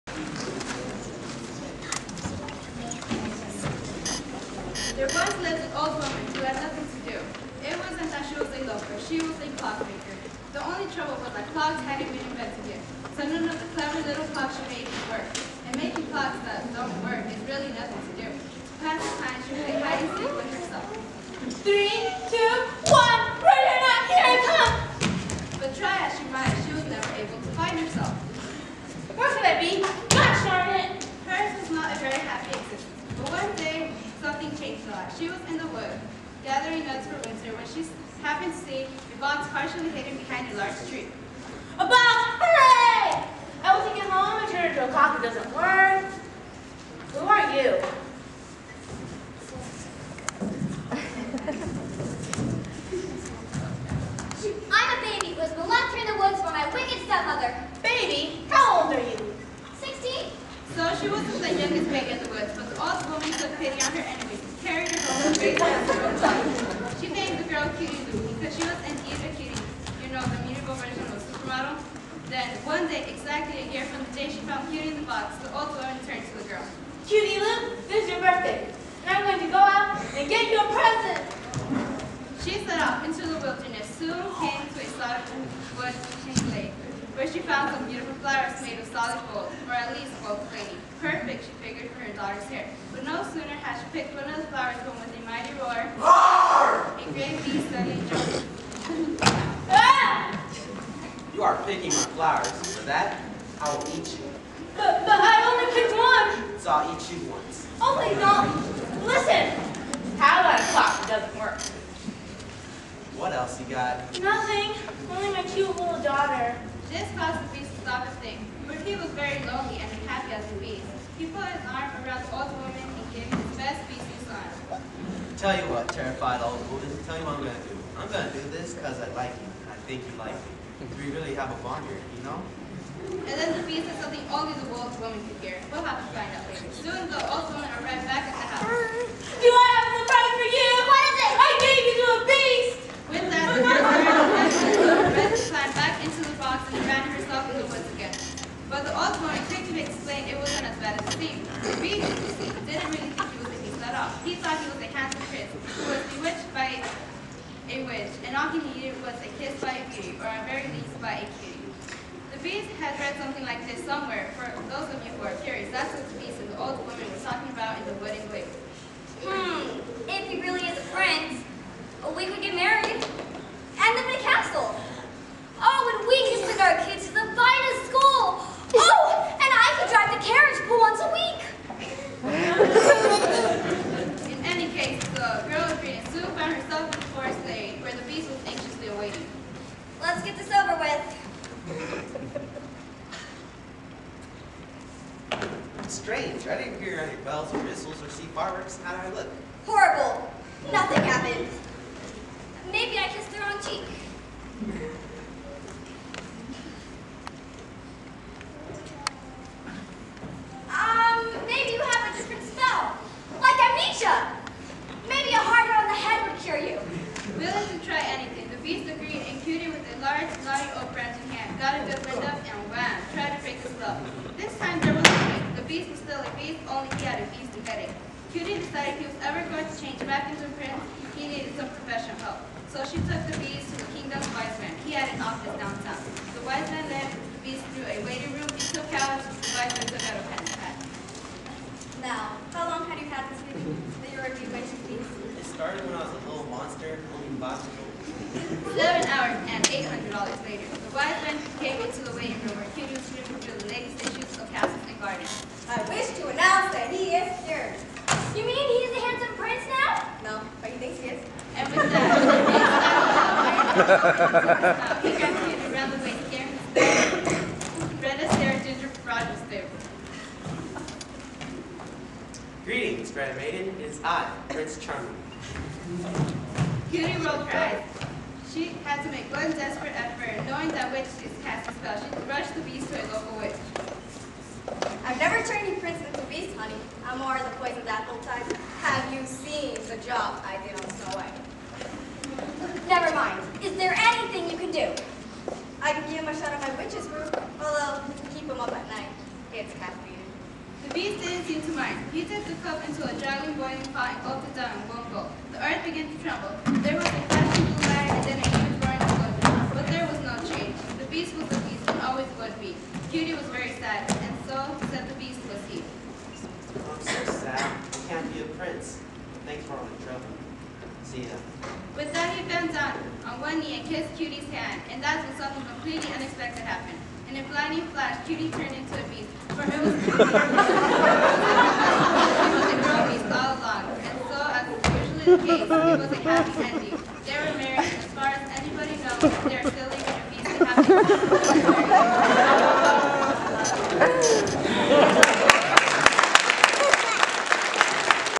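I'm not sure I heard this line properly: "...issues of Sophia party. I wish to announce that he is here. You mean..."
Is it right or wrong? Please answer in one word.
wrong.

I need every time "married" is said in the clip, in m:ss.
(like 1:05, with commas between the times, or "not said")
5:37.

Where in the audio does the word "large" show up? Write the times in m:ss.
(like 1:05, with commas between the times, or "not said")
0:40, 3:40.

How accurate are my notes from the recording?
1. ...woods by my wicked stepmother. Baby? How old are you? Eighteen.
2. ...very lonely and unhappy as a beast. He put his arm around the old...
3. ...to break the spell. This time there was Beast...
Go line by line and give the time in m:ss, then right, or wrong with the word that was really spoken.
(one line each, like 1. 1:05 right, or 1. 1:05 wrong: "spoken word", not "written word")
1. 0:56 wrong: "Sixteen", not "Eighteen"
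2. 1:59 right
3. 3:43 right.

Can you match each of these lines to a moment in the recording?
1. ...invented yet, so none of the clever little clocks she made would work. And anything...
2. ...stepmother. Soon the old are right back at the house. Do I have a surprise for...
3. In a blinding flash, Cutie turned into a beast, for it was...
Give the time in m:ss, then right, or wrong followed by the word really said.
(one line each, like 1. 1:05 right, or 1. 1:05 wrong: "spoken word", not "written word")
1. 0:12 wrong: "making", not "anything"
2. 2:16 wrong: "later", not "stepmother"
3. 5:27 right.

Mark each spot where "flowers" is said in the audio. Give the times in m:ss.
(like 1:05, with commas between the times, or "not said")
1:28, 1:34, 1:42.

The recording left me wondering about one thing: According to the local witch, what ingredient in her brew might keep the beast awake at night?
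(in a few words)
Caffeine.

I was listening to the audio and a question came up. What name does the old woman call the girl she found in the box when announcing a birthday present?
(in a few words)
Cutie Lou.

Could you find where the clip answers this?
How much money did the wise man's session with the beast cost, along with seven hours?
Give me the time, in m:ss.
4:09.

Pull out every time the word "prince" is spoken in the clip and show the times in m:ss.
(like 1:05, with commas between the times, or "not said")
3:50, 4:19, 4:34.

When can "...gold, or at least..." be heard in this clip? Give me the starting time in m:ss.
1:29.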